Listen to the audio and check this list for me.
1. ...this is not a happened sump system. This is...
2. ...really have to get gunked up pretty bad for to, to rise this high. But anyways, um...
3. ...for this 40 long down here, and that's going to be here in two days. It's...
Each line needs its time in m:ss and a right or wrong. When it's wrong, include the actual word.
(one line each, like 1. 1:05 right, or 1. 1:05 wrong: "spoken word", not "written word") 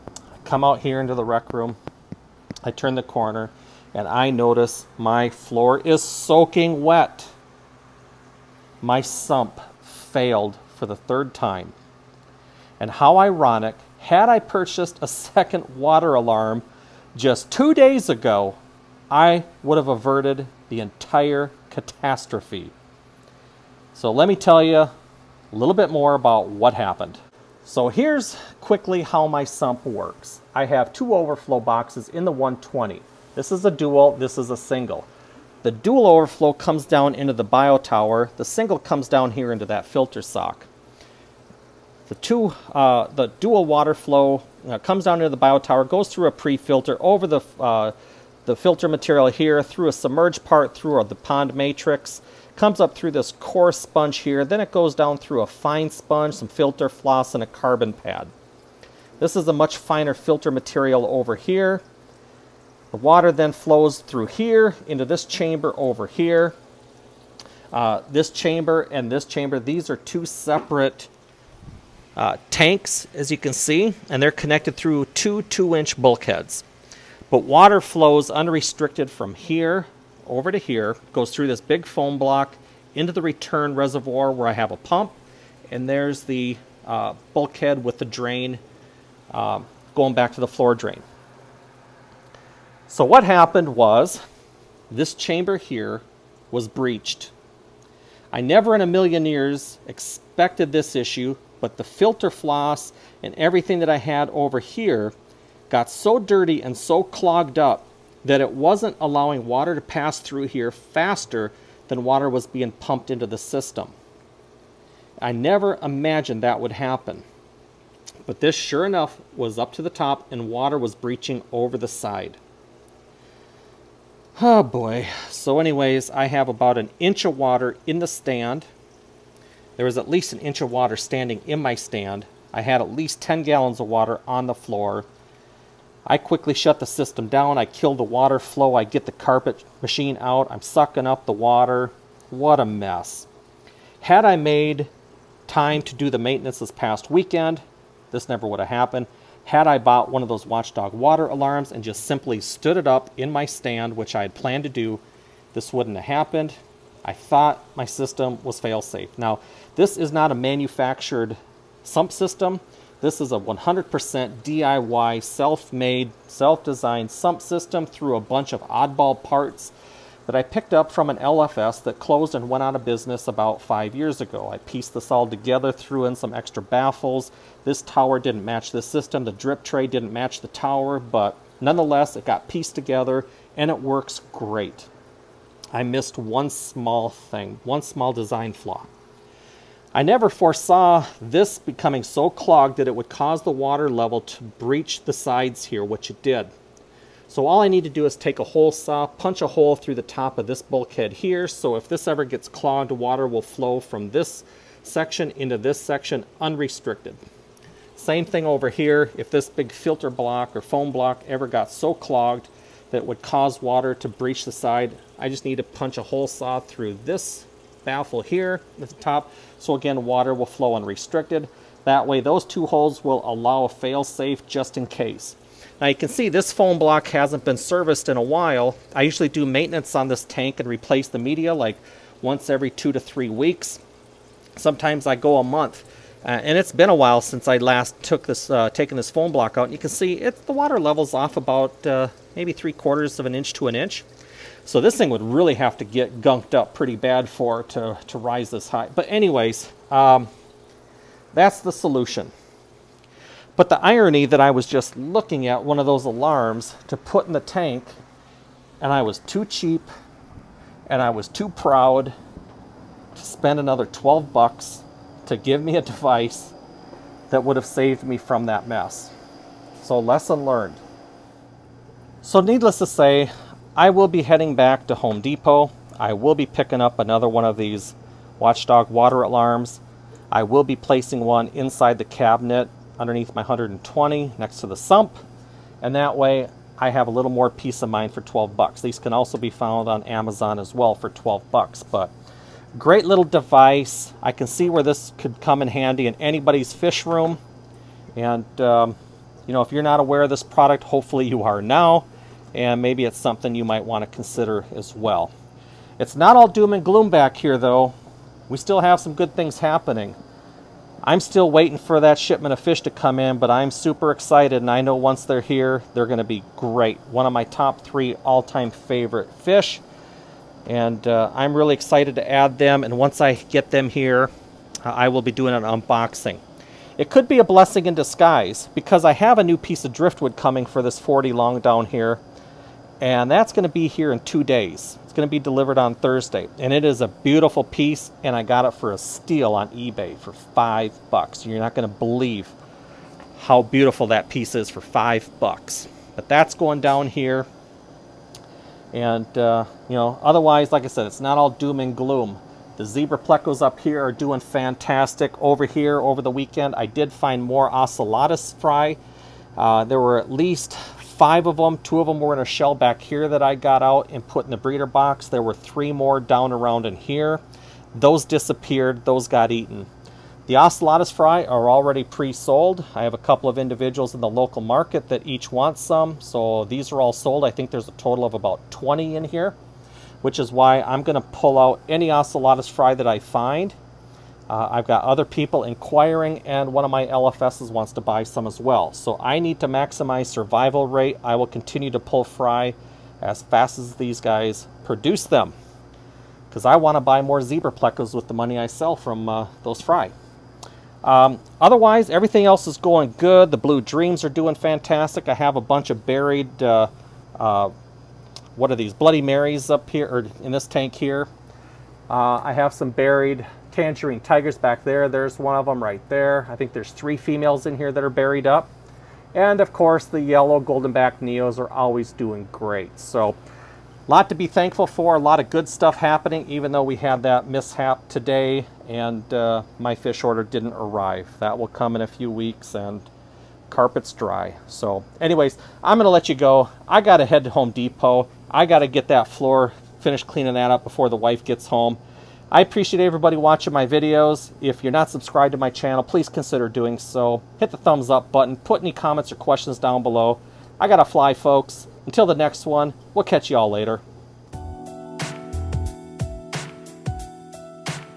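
1. 2:39 wrong: "manufactured", not "happened"
2. 4:05 right
3. 5:30 right.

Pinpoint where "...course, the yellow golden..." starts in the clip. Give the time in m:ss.
6:59.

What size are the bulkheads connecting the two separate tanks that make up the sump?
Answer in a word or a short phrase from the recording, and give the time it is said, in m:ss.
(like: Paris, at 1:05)
2-inch, at 1:15.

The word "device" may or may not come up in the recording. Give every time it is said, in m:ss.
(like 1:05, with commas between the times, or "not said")
4:25, 4:53.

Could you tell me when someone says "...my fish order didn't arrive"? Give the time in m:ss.
7:09.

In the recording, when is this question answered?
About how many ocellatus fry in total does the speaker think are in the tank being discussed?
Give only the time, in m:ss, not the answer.
6:18.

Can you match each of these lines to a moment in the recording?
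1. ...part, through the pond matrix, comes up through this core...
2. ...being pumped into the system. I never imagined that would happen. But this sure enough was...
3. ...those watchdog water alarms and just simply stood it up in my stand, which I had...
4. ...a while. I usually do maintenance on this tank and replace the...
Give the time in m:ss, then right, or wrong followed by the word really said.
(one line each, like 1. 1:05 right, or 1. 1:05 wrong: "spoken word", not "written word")
1. 0:50 right
2. 1:52 right
3. 2:30 right
4. 3:48 right.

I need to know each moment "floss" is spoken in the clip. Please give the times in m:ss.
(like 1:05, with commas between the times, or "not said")
0:56, 1:42.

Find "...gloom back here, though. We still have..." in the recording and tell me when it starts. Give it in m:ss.
5:06.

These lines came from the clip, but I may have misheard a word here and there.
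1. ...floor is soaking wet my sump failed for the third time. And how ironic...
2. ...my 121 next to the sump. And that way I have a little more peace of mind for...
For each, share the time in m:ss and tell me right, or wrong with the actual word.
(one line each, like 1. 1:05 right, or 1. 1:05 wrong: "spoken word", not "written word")
1. 0:05 right
2. 4:43 wrong: "120", not "121".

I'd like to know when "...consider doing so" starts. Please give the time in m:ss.
7:26.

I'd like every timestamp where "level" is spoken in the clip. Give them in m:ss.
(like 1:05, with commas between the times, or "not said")
3:13, 4:00.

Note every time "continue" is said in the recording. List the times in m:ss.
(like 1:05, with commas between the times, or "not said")
6:31.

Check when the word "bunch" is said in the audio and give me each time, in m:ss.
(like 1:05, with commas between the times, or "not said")
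2:48, 6:45.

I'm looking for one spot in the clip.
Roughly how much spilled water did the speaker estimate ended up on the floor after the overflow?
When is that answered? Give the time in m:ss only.
2:13.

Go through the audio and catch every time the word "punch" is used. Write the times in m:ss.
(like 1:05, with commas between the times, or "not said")
3:19, 3:35.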